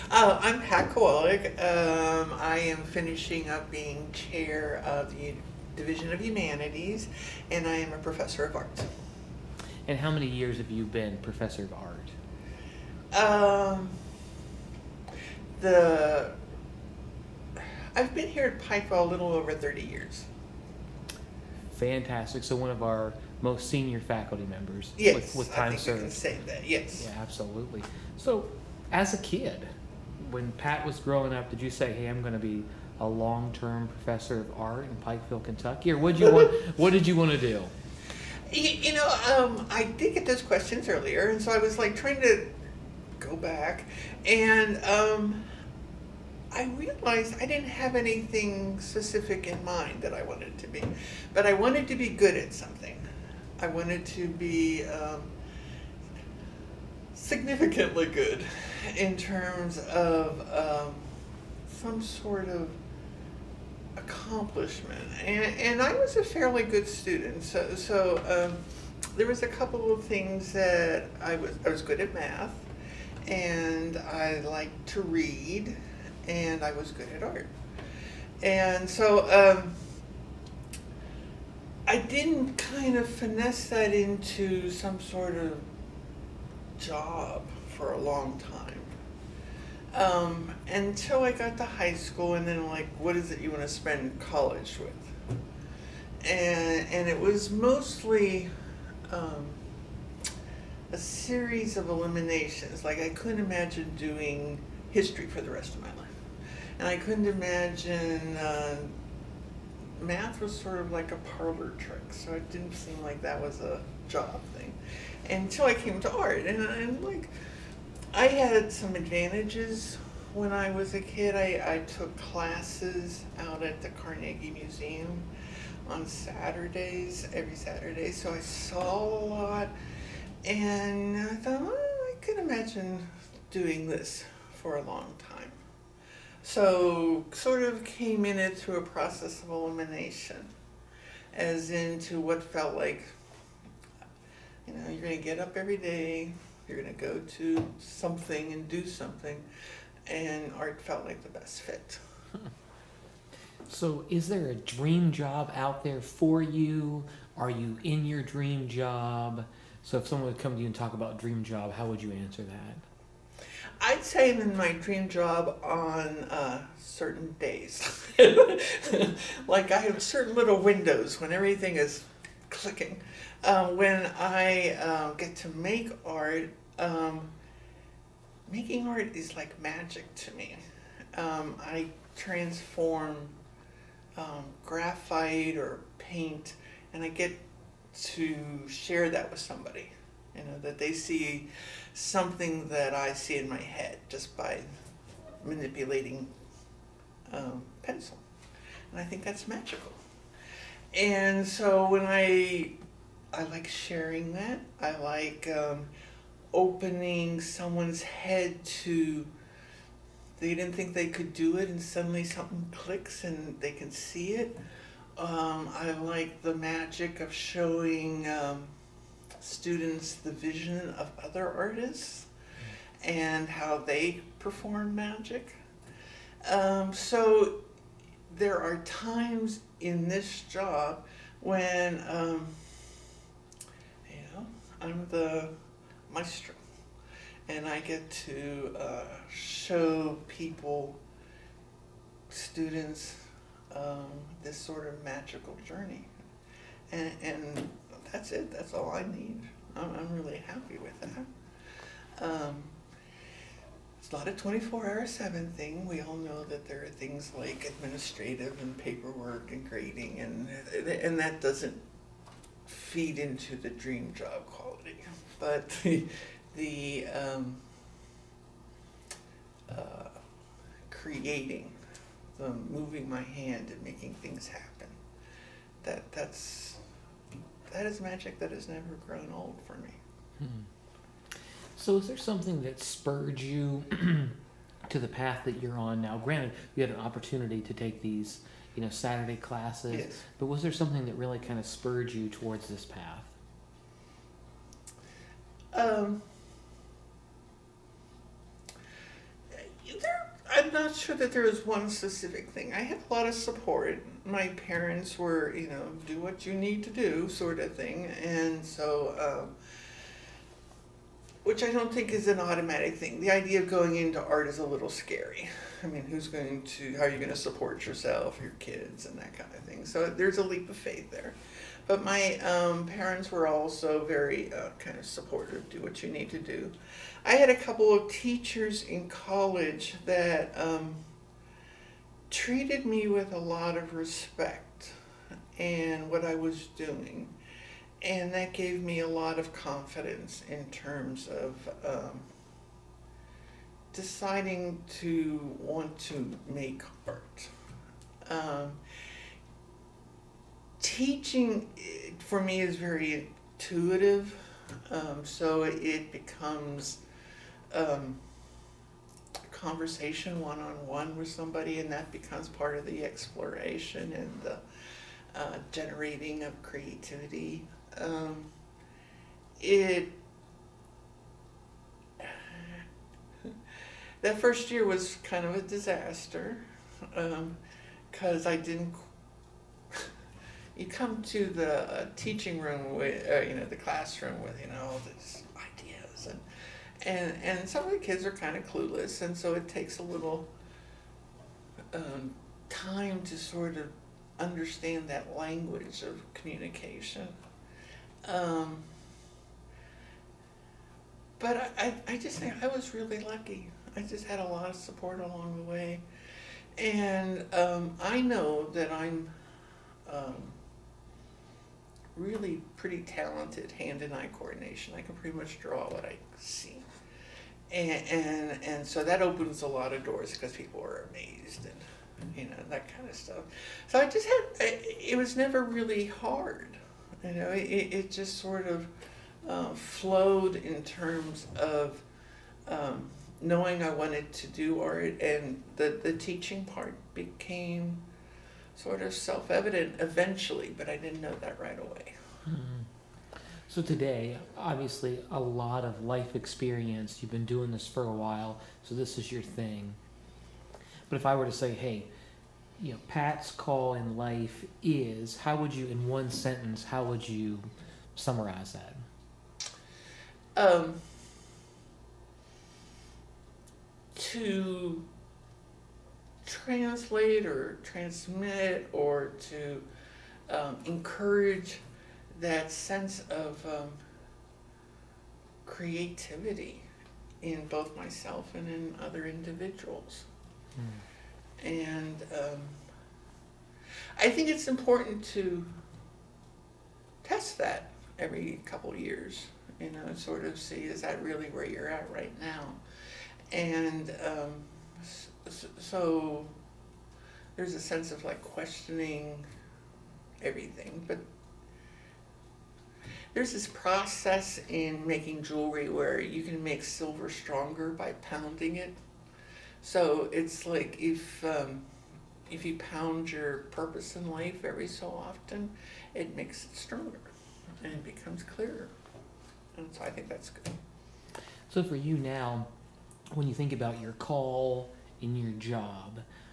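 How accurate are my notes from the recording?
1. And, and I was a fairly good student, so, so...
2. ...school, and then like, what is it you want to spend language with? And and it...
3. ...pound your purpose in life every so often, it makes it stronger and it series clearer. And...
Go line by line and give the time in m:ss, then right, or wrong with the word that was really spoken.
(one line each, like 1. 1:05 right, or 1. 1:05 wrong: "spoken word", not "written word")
1. 1:05 right
2. 1:31 wrong: "college", not "language"
3. 8:32 wrong: "becomes", not "series".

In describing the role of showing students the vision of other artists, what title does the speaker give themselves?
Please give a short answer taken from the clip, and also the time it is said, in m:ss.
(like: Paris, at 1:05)
Maestro, at 3:56.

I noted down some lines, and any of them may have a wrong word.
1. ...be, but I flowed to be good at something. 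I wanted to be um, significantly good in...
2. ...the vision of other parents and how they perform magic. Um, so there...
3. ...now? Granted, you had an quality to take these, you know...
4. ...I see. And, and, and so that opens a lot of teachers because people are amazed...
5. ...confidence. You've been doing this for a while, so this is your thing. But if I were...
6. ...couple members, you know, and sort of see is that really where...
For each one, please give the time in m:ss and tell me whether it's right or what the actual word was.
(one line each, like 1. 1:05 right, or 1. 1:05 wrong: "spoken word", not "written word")
1. 0:50 wrong: "wanted", not "flowed"
2. 3:40 wrong: "artists", not "parents"
3. 4:46 wrong: "opportunity", not "quality"
4. 6:56 wrong: "doors", not "teachers"
5. 7:26 wrong: "experience", not "confidence"
6. 8:08 wrong: "years", not "members".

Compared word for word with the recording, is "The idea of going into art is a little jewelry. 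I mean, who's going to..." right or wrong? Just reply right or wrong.
wrong.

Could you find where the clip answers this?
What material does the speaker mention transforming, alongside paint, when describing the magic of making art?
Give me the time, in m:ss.
3:04.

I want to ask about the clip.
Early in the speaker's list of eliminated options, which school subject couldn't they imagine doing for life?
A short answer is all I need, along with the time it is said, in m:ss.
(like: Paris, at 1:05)
History, at 1:44.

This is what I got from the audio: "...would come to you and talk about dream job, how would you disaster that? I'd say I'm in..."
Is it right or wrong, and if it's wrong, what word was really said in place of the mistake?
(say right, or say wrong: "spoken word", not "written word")
wrong: "answer", not "disaster".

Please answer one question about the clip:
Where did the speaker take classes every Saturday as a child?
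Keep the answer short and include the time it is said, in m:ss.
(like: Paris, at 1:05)
Carnegie Museum, at 2:03.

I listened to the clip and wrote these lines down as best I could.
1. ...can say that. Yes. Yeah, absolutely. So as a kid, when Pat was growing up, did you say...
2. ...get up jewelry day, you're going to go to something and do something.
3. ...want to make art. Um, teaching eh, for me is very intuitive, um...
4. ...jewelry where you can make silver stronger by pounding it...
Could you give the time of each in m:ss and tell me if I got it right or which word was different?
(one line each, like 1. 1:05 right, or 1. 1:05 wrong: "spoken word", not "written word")
1. 0:26 right
2. 2:25 wrong: "every", not "jewelry"
3. 5:45 right
4. 8:25 right.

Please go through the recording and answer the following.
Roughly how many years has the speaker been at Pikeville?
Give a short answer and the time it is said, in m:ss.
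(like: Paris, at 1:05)
a little over 30, at 0:19.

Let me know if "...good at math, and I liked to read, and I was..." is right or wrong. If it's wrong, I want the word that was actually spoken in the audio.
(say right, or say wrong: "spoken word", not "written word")
right.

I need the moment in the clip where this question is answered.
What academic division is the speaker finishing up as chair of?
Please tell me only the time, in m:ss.
0:05.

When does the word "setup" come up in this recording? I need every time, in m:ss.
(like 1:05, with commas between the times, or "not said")
not said.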